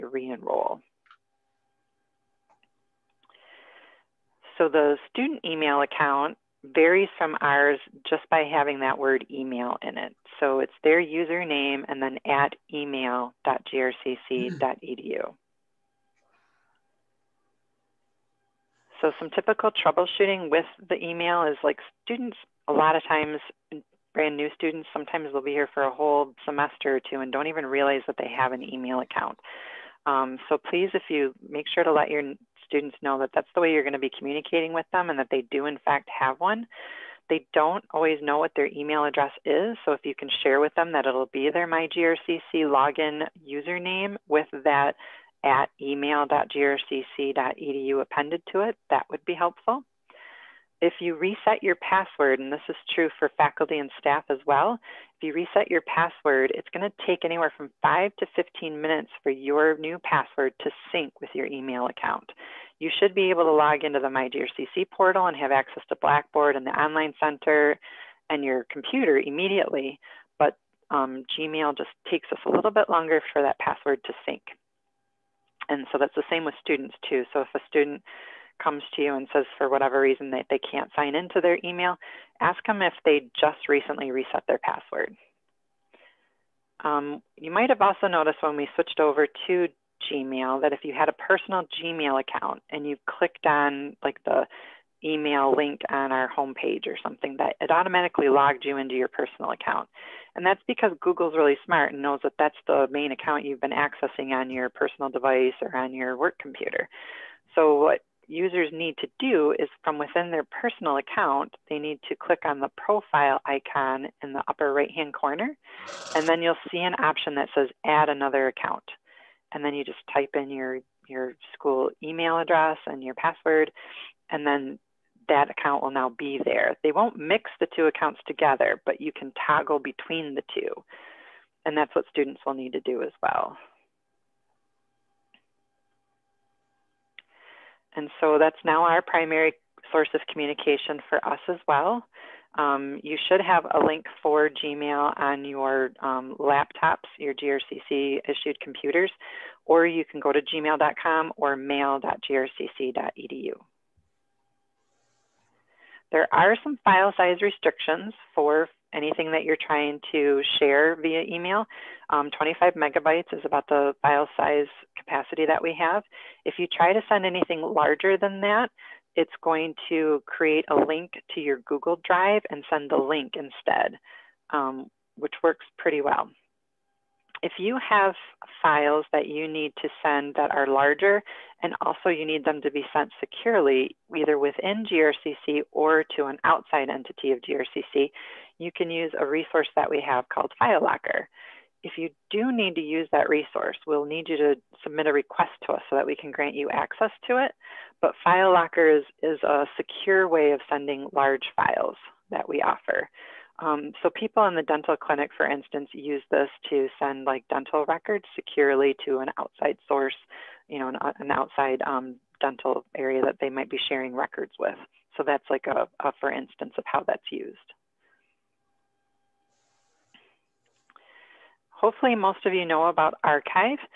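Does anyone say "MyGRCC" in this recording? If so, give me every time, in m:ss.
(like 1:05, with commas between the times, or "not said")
0:41, 1:04.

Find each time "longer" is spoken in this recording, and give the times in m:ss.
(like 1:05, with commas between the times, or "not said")
1:12.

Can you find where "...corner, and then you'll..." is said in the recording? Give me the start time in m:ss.
1:55.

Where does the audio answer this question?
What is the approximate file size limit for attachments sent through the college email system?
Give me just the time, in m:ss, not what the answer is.
2:42.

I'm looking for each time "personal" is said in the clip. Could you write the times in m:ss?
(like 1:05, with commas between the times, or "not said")
1:31, 1:39, 1:44, 1:50.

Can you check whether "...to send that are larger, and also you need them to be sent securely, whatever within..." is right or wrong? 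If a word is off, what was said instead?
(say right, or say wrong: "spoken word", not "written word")
wrong: "either", not "whatever".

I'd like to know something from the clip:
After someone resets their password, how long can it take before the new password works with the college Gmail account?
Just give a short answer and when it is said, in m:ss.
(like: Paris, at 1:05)
5 to 15 minutes, at 0:57.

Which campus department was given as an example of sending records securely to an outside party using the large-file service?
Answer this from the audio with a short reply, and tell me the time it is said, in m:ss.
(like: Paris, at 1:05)
dental clinic, at 3:24.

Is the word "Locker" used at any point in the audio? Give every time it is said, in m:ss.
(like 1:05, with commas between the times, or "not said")
3:10, 3:18.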